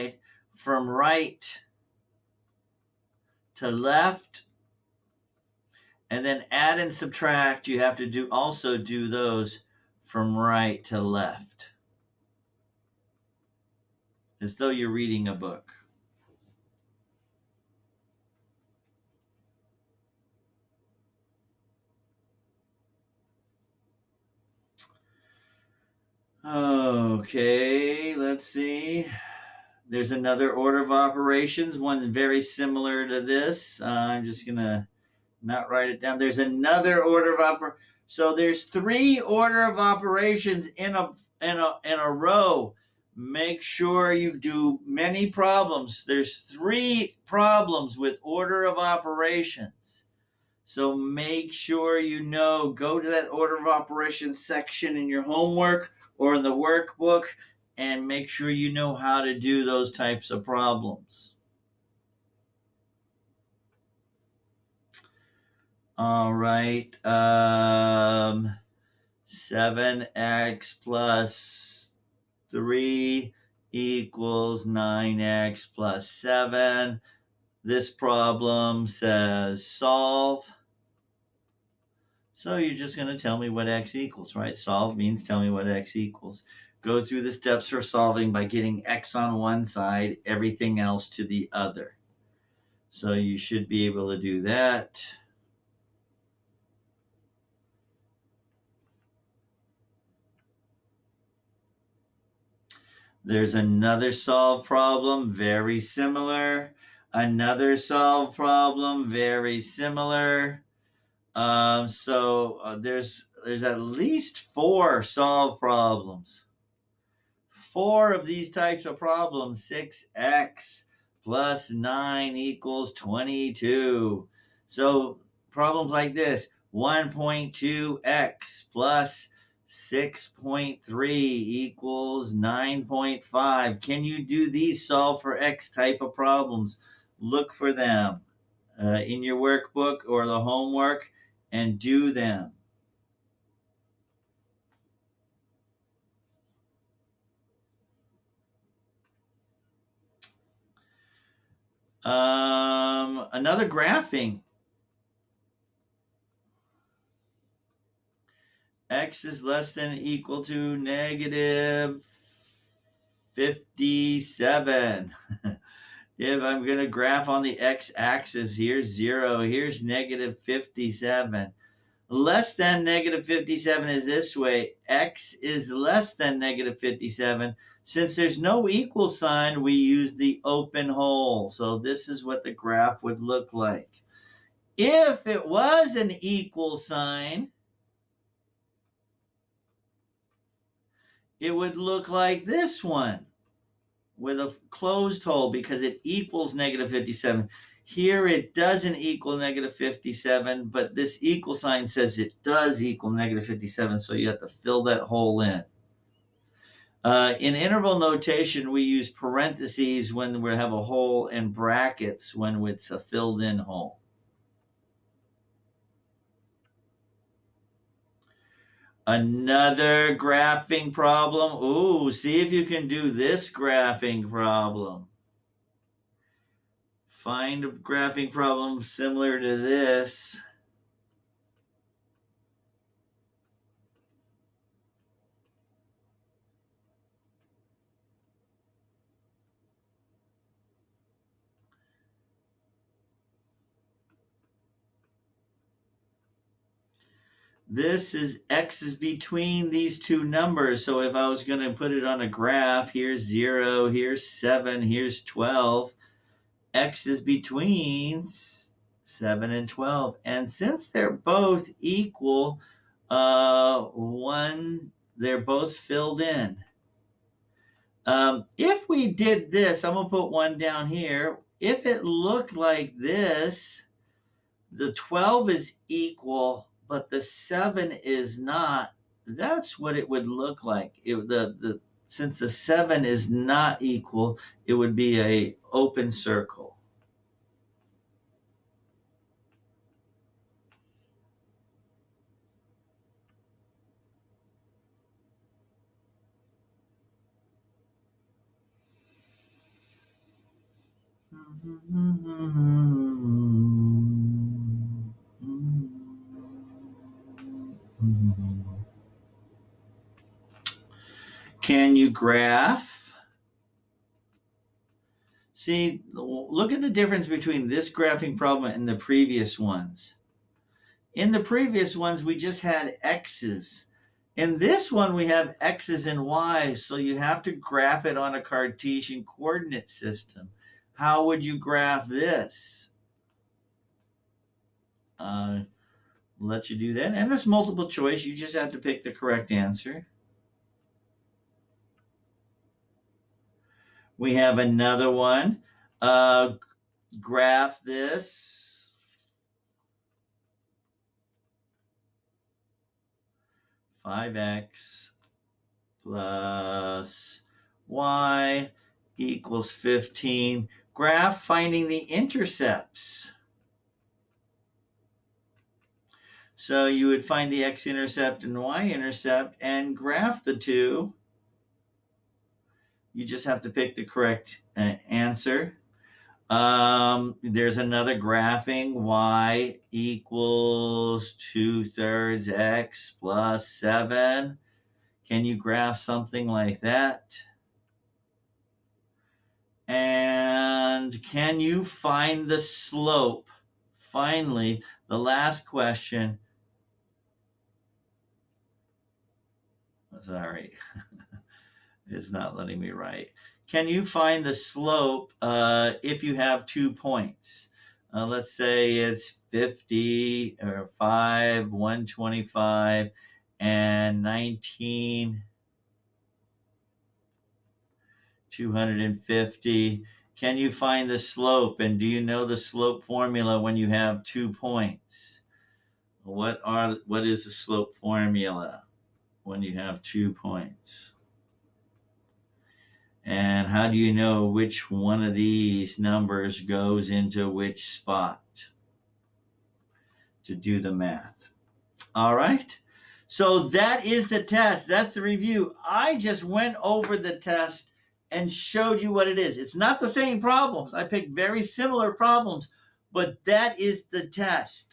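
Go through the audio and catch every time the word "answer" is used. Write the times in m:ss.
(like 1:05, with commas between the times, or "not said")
5:39, 6:15.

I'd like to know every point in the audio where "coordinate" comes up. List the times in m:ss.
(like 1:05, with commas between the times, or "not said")
5:29.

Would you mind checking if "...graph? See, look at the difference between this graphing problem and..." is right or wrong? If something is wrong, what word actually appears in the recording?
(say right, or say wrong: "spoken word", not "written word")
right.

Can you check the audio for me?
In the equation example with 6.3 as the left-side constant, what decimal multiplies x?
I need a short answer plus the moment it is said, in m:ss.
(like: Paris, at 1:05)
1.2, at 2:06.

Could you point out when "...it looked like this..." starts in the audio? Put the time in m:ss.
4:31.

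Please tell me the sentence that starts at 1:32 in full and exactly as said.
So you should be able to do that.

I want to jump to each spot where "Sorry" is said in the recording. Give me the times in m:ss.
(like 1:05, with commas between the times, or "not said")
6:40.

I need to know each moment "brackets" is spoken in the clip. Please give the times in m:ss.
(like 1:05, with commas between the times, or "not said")
3:31.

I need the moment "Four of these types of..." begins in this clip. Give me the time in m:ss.
1:57.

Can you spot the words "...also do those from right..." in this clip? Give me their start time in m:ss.
0:08.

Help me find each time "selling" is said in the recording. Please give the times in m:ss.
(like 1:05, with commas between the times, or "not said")
not said.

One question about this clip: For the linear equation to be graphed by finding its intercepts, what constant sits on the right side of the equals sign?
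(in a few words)
15.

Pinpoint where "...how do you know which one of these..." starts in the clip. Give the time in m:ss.
7:13.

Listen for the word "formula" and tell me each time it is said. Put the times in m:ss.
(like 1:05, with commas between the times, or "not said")
7:03, 7:07.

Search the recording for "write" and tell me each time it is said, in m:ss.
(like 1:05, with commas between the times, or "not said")
0:35, 6:42.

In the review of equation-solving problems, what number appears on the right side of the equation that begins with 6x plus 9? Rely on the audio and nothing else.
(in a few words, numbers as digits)
22.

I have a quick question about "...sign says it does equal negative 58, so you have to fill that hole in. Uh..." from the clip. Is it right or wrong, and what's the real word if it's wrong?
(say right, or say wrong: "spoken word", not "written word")
wrong: "57", not "58".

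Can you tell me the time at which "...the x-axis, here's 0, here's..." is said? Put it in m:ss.
2:47.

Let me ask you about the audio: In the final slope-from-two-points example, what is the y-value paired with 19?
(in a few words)
250.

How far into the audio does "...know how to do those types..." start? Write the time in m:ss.
0:58.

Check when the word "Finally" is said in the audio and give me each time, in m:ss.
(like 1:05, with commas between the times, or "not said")
6:33.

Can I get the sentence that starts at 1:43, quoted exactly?
There's another solve problem, very similar.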